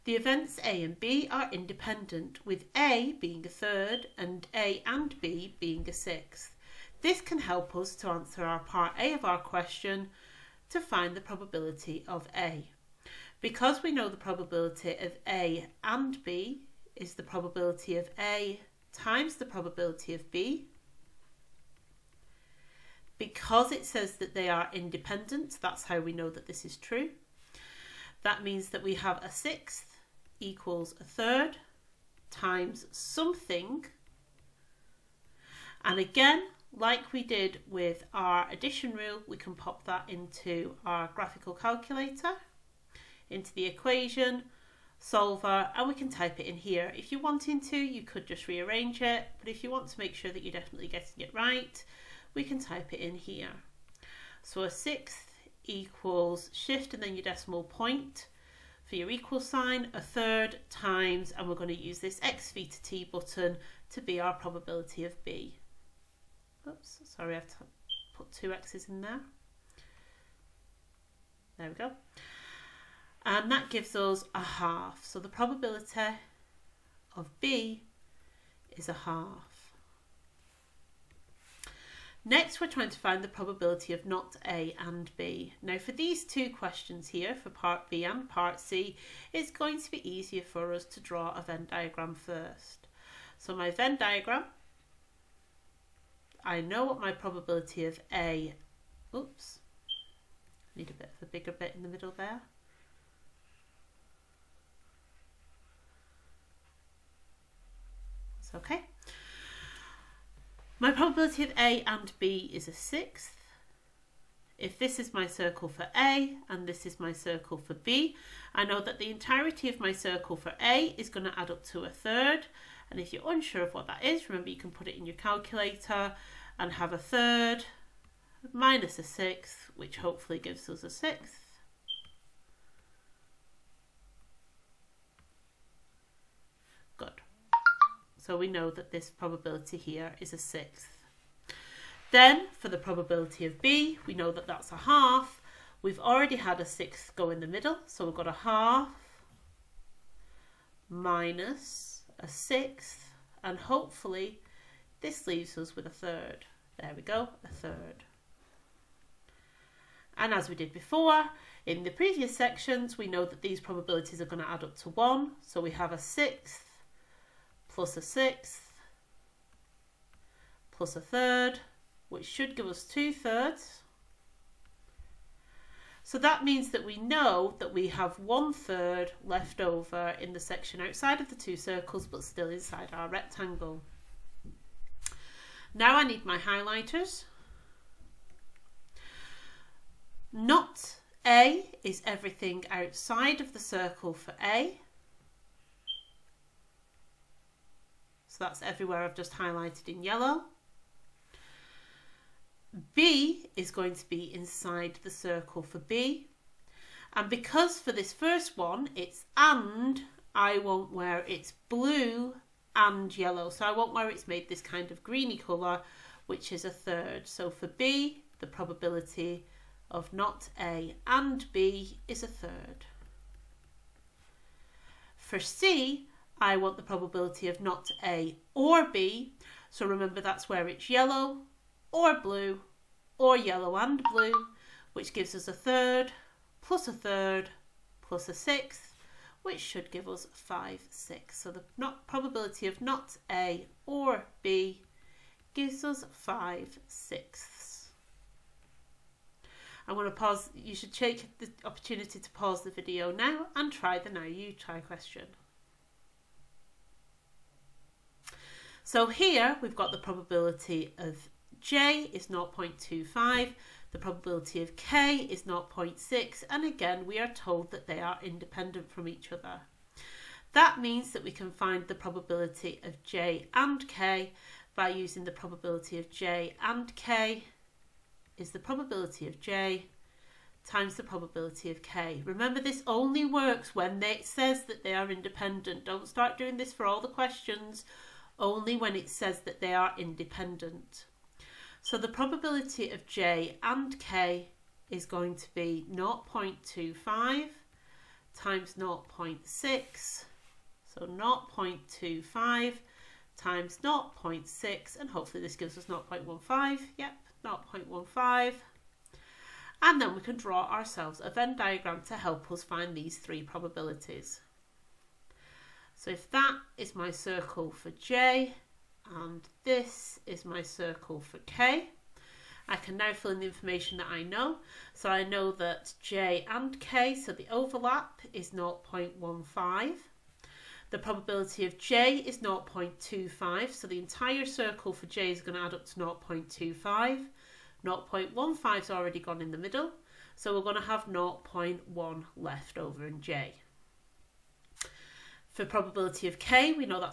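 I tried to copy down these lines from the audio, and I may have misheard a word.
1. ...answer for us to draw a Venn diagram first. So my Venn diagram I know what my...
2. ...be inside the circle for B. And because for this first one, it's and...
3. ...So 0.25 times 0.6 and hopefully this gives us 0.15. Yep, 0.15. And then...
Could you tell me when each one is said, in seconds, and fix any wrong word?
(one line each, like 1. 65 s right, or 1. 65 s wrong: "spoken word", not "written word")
1. 90 s wrong: "easier", not "answer"
2. 204 s right
3. 300 s right.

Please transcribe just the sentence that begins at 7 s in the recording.
This can help us to answer our part A of our question to find the probability of A.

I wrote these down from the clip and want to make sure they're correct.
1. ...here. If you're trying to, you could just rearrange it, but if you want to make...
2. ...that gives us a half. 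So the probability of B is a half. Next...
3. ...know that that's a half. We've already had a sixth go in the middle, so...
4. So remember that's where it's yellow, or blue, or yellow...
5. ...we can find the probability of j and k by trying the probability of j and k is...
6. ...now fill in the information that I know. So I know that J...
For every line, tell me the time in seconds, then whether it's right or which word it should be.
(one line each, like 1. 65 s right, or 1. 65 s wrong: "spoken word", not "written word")
1. 46 s wrong: "wanting", not "trying"
2. 73 s right
3. 144 s right
4. 229 s right
5. 271 s wrong: "using", not "trying"
6. 322 s right.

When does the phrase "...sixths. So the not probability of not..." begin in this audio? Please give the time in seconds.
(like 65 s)
240 s.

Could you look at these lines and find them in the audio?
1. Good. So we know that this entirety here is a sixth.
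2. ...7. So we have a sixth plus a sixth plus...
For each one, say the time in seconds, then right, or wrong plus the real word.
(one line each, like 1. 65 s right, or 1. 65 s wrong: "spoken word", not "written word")
1. 136 s wrong: "probability", not "entirety"
2. 164 s wrong: "1", not "7".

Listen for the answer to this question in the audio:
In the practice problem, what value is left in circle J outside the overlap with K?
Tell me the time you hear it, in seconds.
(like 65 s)
341 s.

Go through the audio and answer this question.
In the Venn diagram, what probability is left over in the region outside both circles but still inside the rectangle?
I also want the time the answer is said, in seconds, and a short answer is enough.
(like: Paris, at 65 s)
1/3, at 178 s.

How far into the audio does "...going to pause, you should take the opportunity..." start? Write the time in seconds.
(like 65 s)
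249 s.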